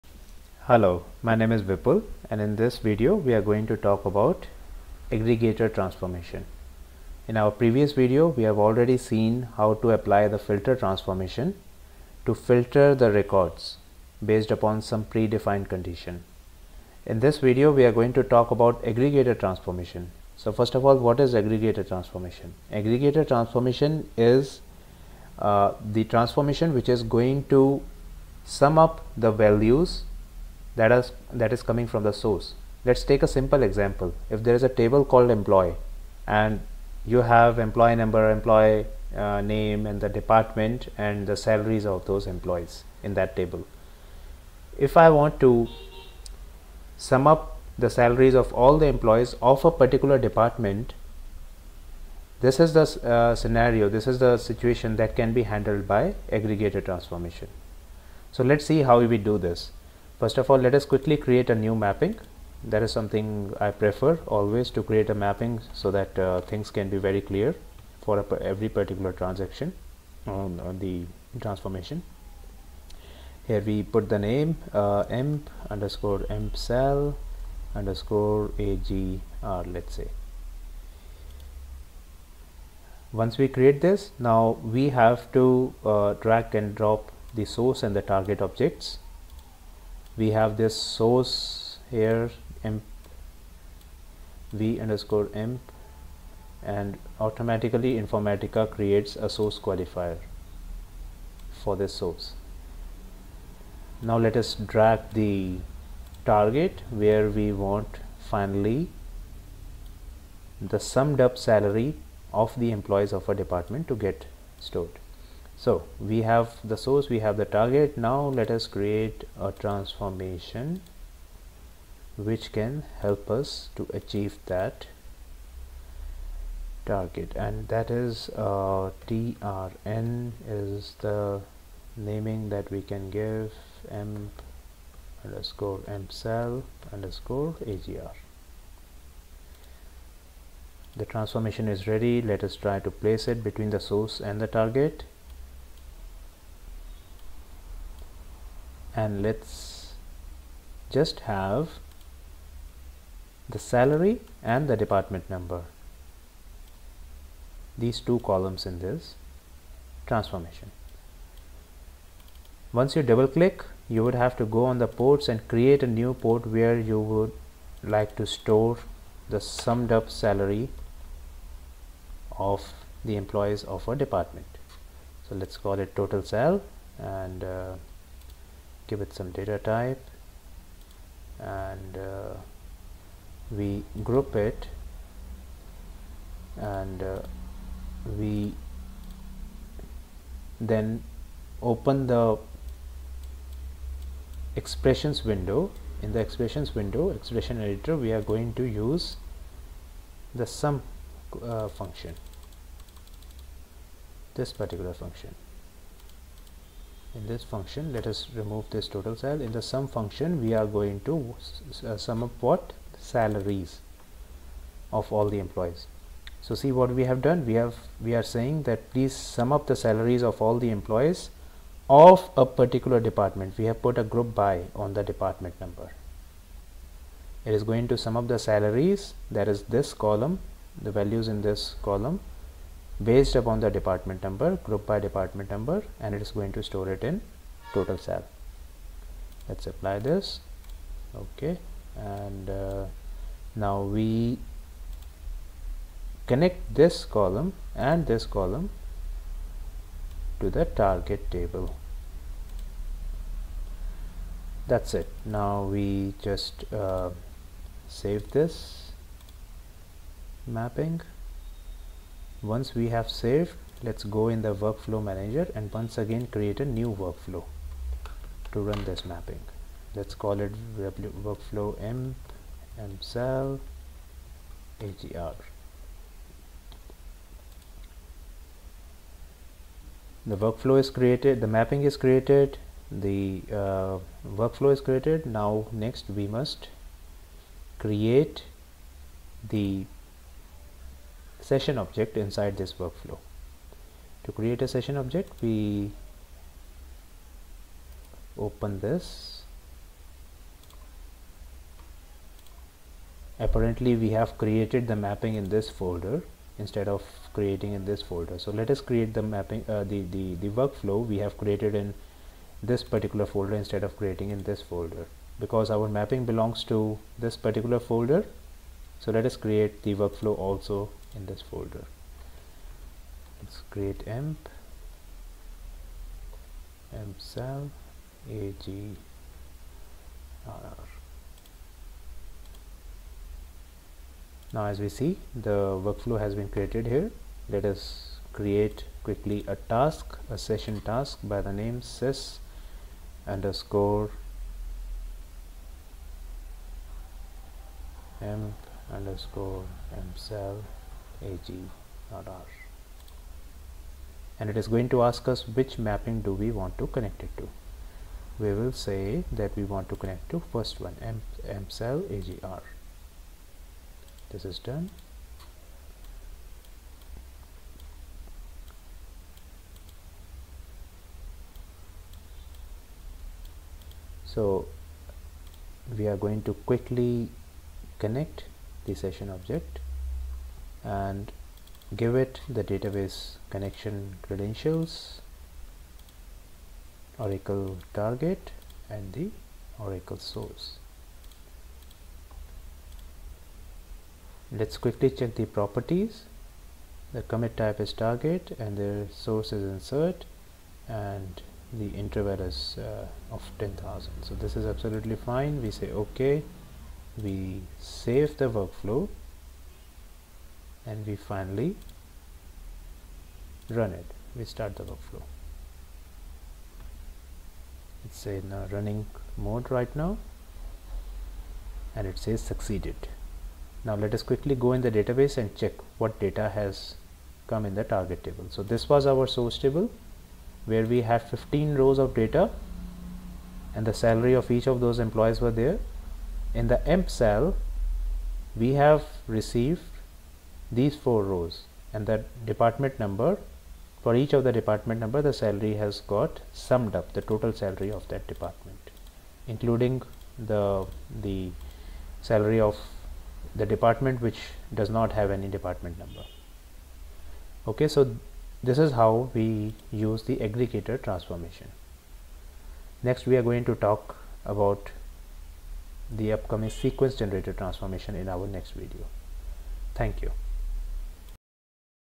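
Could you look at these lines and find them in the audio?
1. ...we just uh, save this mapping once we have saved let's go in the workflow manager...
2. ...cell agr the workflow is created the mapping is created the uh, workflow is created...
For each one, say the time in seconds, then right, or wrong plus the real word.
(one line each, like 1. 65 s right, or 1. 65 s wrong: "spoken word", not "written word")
1. 255 s right
2. 272 s right.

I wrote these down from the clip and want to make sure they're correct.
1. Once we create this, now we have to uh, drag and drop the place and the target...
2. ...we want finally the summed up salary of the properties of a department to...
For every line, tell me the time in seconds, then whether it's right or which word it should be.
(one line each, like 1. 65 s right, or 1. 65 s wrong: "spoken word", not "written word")
1. 83 s wrong: "source", not "place"
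2. 107 s wrong: "employees", not "properties".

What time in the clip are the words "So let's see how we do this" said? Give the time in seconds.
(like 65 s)
58 s.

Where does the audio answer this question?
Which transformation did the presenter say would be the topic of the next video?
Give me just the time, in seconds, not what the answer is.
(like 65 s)
466 s.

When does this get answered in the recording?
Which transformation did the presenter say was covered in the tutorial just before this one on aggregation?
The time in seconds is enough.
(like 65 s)
10 s.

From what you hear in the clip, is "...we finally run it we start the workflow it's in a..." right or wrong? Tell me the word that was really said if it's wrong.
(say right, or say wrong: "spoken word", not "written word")
right.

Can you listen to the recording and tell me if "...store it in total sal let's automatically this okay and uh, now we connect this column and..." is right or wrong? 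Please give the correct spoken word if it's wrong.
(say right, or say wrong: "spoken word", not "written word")
wrong: "apply", not "automatically".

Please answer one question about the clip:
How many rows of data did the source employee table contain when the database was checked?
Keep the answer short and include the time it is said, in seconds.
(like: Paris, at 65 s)
15, at 431 s.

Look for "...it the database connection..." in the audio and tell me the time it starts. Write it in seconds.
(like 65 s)
382 s.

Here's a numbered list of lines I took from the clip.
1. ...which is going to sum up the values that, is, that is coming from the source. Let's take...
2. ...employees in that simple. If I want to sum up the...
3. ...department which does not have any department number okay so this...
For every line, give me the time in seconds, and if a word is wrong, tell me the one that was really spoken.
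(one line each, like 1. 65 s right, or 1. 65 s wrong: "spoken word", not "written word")
1. 26 s right
2. 42 s wrong: "table", not "simple"
3. 453 s right.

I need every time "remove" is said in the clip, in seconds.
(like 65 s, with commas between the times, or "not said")
208 s.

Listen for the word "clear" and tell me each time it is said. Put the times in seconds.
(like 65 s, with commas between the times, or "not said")
67 s.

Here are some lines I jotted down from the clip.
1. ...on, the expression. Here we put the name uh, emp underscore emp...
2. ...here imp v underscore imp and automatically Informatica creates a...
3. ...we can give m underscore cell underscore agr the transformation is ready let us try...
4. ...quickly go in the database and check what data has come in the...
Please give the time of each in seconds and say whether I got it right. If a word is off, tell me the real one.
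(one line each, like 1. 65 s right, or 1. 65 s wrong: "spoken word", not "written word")
1. 70 s wrong: "transformation", not "expression"
2. 91 s right
3. 132 s right
4. 424 s right.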